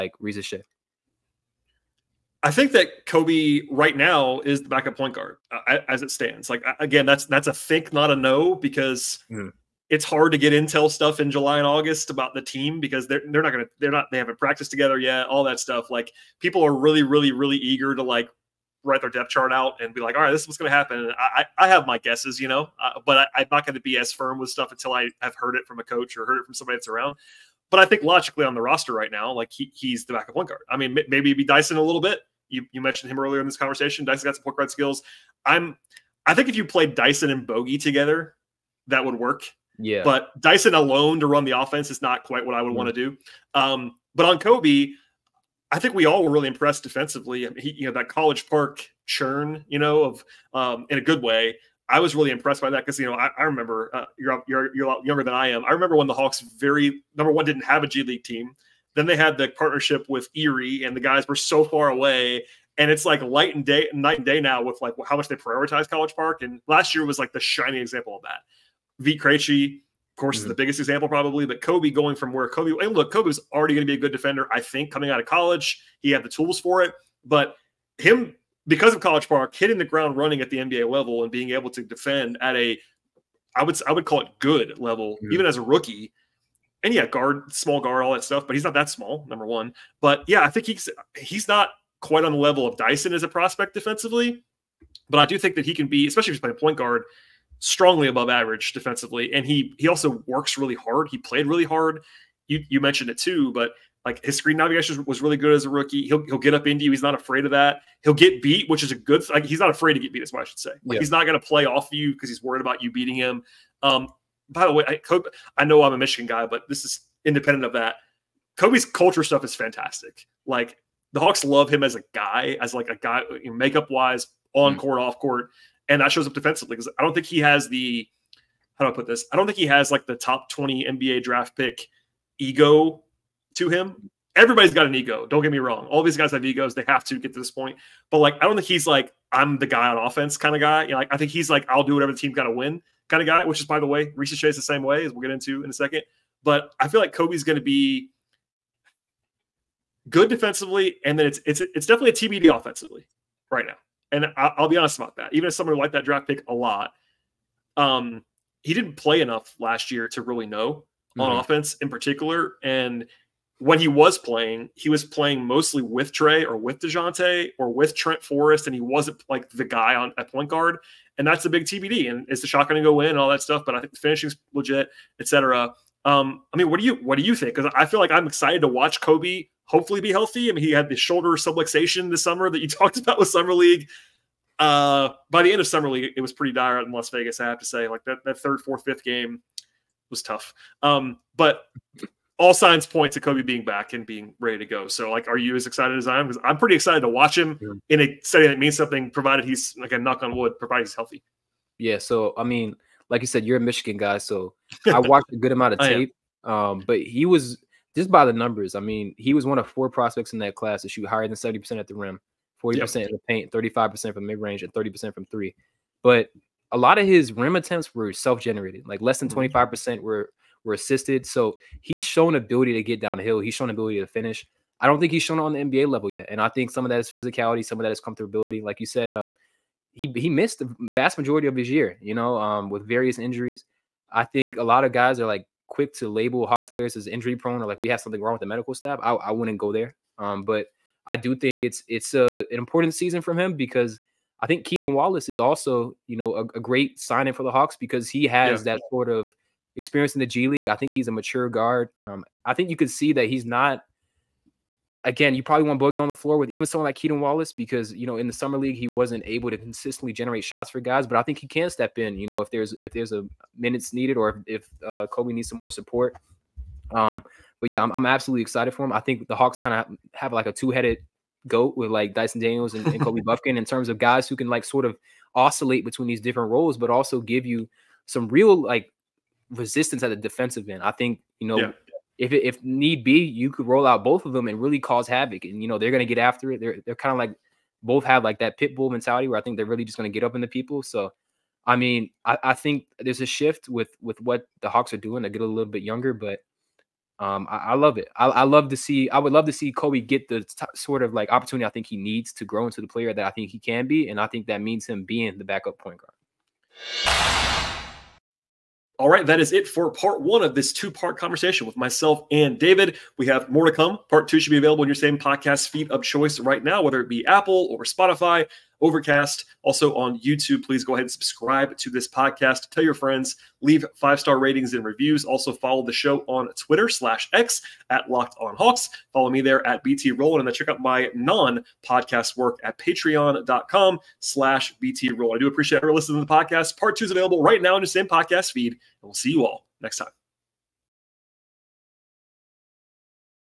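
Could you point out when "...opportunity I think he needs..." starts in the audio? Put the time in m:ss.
5:01.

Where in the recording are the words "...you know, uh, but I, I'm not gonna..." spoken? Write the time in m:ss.
0:22.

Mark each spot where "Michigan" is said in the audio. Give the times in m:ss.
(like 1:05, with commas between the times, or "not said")
1:55, 3:23.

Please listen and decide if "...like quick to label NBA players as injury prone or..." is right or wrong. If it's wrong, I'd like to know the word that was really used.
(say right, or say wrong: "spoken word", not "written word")
wrong: "Hawks", not "NBA".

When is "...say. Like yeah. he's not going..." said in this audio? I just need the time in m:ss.
1:50.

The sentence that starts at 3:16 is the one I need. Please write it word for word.
Because I'm pretty excited to watch him yeah.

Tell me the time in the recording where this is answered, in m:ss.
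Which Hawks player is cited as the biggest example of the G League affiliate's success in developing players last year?
1:08.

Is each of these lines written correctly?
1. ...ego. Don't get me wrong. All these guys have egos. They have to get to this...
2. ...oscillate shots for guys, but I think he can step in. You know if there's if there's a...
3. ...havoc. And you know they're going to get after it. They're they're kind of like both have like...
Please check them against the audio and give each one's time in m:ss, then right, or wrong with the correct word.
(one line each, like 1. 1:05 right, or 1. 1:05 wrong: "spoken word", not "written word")
1. 2:14 right
2. 4:20 wrong: "generate", not "oscillate"
3. 4:45 right.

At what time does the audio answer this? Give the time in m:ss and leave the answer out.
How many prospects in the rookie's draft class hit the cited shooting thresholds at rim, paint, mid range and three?
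3:29.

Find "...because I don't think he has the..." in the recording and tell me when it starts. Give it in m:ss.
2:06.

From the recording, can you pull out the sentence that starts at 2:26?
But I feel like Kobe's going to be good defensively, and then it's it's it's definitely a TBD offensively right now.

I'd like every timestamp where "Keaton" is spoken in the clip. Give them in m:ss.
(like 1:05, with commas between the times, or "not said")
4:04, 4:16.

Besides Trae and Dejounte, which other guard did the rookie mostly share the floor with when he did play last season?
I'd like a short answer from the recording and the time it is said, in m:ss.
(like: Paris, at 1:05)
Trent Forrest, at 2:47.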